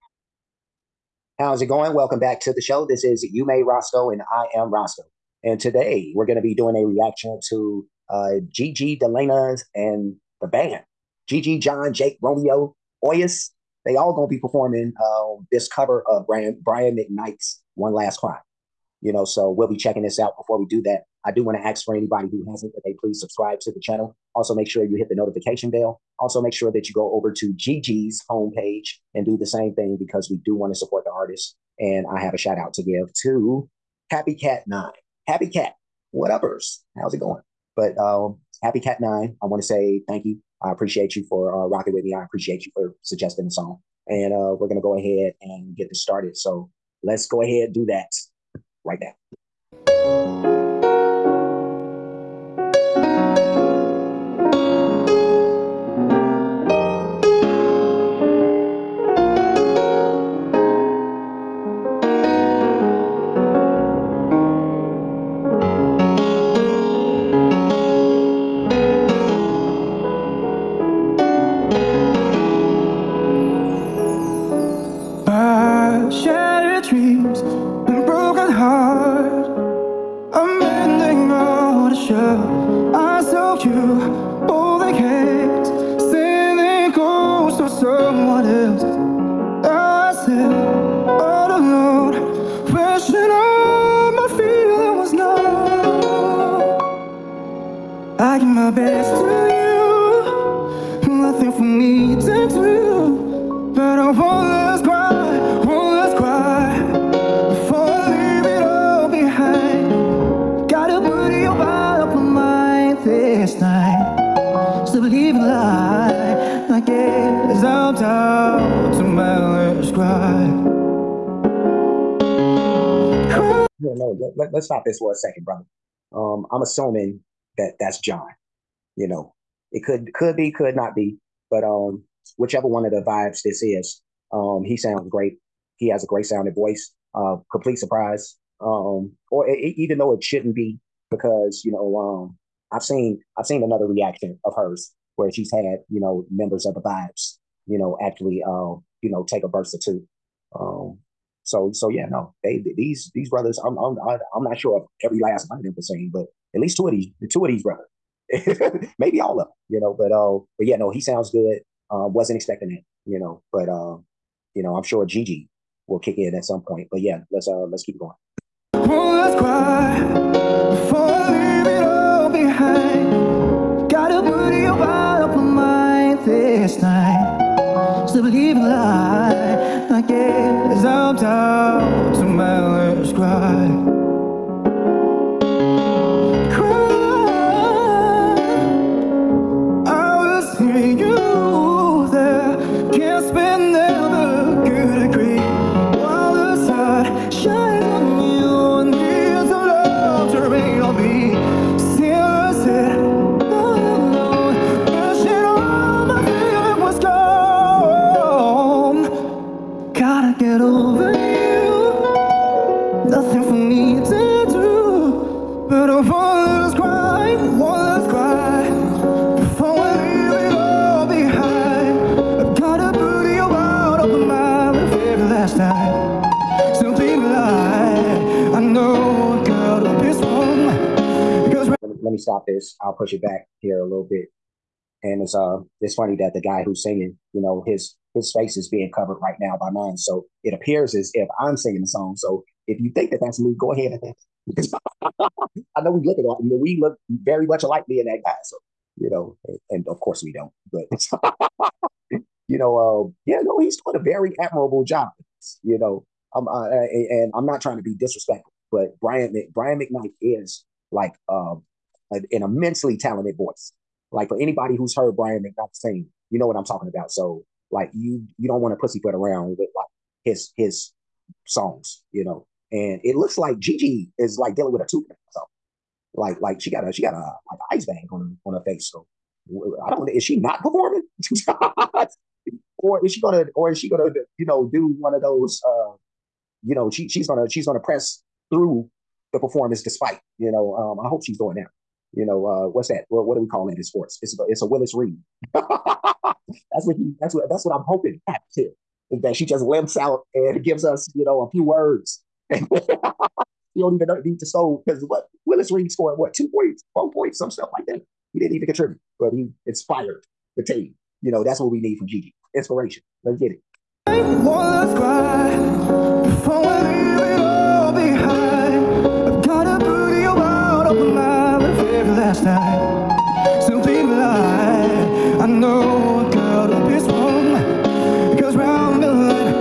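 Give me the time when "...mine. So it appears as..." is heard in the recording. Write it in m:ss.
3:59.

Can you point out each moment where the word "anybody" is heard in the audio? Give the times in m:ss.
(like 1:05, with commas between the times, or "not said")
0:21, 4:24.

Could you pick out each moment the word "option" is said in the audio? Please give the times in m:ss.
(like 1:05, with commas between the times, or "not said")
not said.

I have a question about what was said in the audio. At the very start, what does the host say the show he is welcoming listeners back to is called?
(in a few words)
You Made Roskoe.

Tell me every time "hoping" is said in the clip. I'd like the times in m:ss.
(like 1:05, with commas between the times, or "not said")
4:57.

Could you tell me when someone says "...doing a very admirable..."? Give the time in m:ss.
4:13.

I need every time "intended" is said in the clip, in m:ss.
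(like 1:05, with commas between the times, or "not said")
not said.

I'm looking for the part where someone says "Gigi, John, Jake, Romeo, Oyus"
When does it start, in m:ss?
0:11.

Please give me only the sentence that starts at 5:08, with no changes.
He didn't even contribute, but he inspired the team.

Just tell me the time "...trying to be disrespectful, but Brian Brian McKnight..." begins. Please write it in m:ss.
4:17.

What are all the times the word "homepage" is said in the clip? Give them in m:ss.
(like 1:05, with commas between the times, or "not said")
0:28.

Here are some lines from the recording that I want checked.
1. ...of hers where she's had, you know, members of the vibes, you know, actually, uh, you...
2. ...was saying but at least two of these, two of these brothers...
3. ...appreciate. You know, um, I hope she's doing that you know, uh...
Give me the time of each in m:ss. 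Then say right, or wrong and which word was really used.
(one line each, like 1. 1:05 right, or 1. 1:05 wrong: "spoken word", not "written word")
1. 2:24 right
2. 2:35 right
3. 4:49 wrong: "despite", not "appreciate".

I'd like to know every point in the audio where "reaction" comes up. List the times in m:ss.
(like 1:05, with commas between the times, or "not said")
0:06, 2:23.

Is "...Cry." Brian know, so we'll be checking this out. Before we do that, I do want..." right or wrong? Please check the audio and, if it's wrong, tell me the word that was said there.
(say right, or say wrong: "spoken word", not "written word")
wrong: "You", not "Brian".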